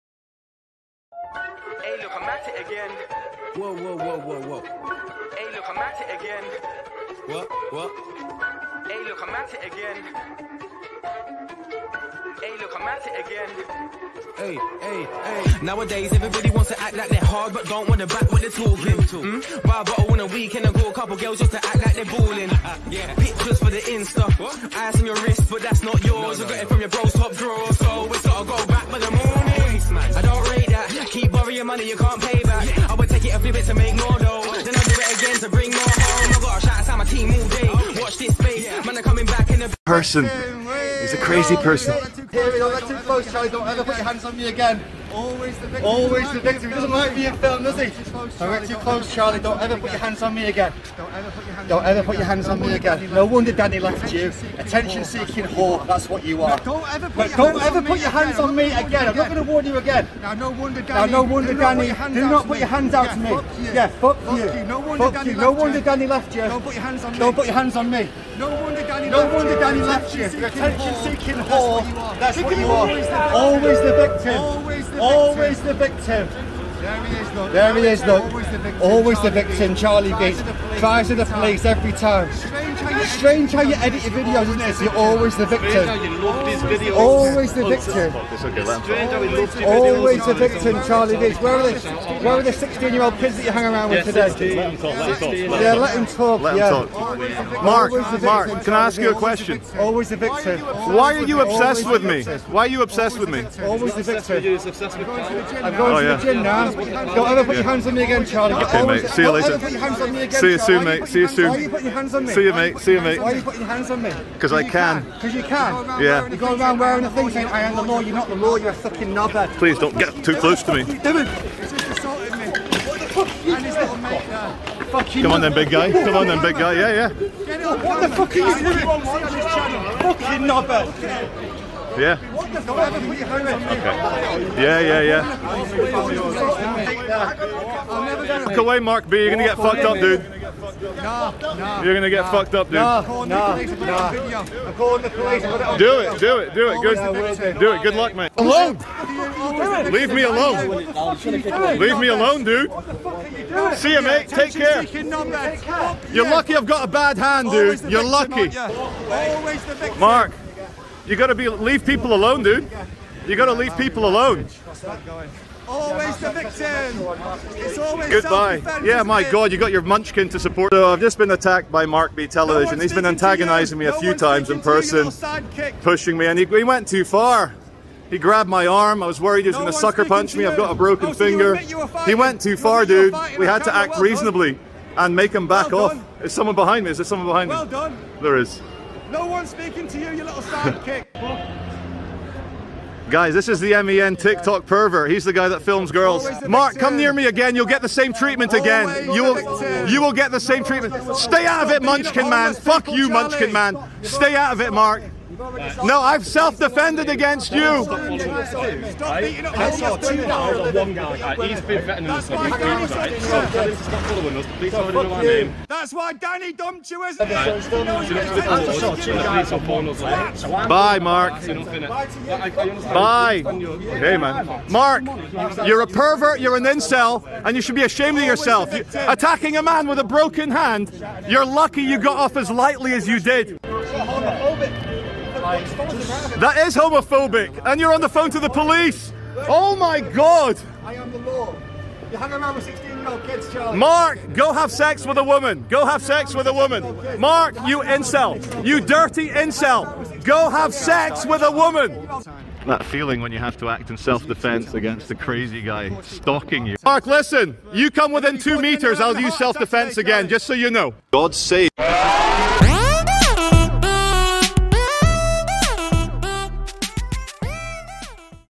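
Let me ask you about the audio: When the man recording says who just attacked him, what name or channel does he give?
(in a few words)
Mark B Television.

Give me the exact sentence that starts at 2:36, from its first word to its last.
You're lucky I've got a bad hand, dude.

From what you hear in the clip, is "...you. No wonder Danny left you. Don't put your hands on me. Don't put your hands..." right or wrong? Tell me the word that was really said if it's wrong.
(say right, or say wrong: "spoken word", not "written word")
right.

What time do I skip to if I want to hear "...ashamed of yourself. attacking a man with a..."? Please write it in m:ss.
3:47.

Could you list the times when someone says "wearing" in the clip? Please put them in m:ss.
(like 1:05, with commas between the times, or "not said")
1:56.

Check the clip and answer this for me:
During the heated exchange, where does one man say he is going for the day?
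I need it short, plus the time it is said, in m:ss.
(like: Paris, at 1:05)
the gym, at 1:46.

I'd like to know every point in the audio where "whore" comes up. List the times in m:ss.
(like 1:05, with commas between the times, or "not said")
0:55, 1:11.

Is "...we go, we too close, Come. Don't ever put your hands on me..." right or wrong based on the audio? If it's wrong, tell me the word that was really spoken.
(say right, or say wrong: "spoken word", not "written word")
wrong: "Charlie", not "Come".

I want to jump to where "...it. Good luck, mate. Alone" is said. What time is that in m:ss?
2:27.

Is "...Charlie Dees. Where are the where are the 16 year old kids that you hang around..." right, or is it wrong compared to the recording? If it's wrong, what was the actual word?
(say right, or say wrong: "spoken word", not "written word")
right.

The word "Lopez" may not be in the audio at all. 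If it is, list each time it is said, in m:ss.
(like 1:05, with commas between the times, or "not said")
not said.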